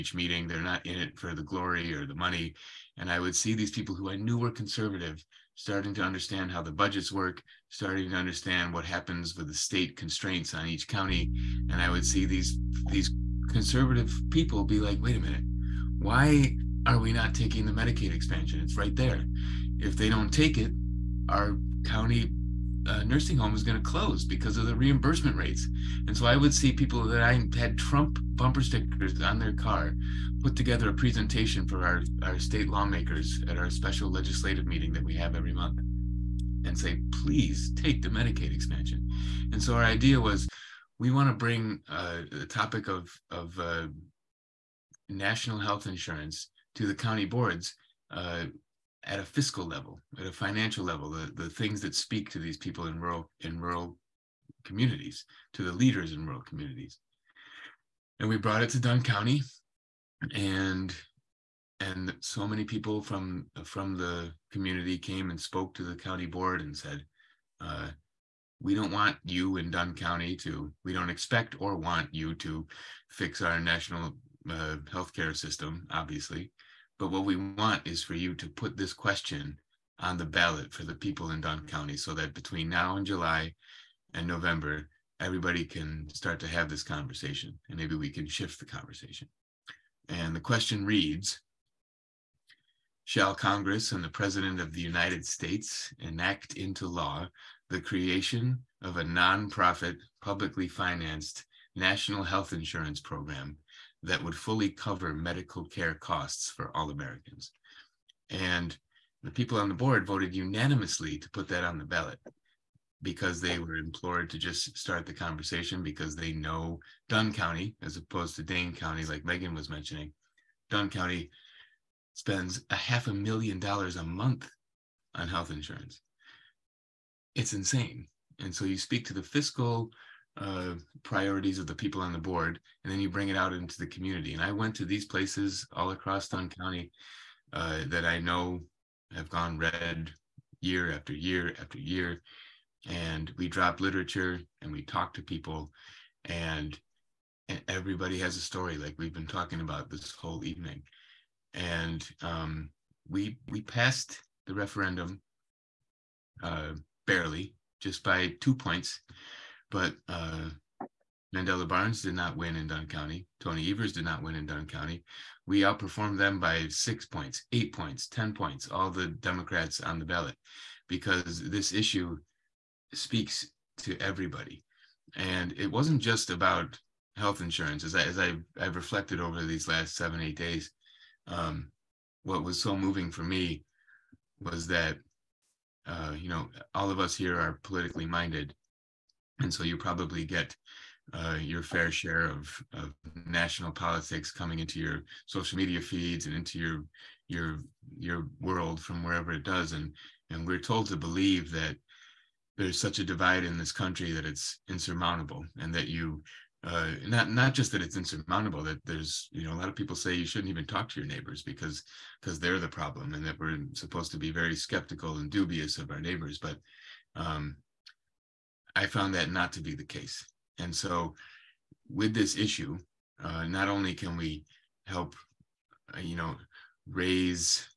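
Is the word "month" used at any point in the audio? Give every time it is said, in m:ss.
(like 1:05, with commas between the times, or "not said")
0:35, 2:04.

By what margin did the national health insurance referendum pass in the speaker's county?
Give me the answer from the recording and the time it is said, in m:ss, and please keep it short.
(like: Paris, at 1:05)
2 points, at 2:38.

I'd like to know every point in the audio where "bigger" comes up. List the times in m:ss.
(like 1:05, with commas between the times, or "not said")
not said.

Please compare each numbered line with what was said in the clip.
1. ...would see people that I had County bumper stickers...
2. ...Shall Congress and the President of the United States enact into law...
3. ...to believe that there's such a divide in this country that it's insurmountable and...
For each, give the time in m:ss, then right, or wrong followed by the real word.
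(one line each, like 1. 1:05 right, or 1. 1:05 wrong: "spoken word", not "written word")
1. 0:26 wrong: "Trump", not "County"
2. 1:33 right
3. 3:20 right.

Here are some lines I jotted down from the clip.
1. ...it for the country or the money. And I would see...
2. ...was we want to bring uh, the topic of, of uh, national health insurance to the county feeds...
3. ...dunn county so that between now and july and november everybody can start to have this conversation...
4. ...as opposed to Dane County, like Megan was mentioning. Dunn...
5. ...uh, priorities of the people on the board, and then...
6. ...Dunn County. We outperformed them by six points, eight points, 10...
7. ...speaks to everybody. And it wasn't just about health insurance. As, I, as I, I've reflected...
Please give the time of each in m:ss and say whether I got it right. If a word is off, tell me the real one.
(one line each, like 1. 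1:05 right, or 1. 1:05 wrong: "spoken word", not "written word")
1. 0:00 wrong: "glory", not "country"
2. 0:40 wrong: "boards", not "feeds"
3. 1:21 right
4. 1:57 right
5. 2:10 right
6. 2:44 right
7. 2:52 right.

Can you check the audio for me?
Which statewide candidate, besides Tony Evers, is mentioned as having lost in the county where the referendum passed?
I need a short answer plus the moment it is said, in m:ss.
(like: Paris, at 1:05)
Mandela Barnes, at 2:41.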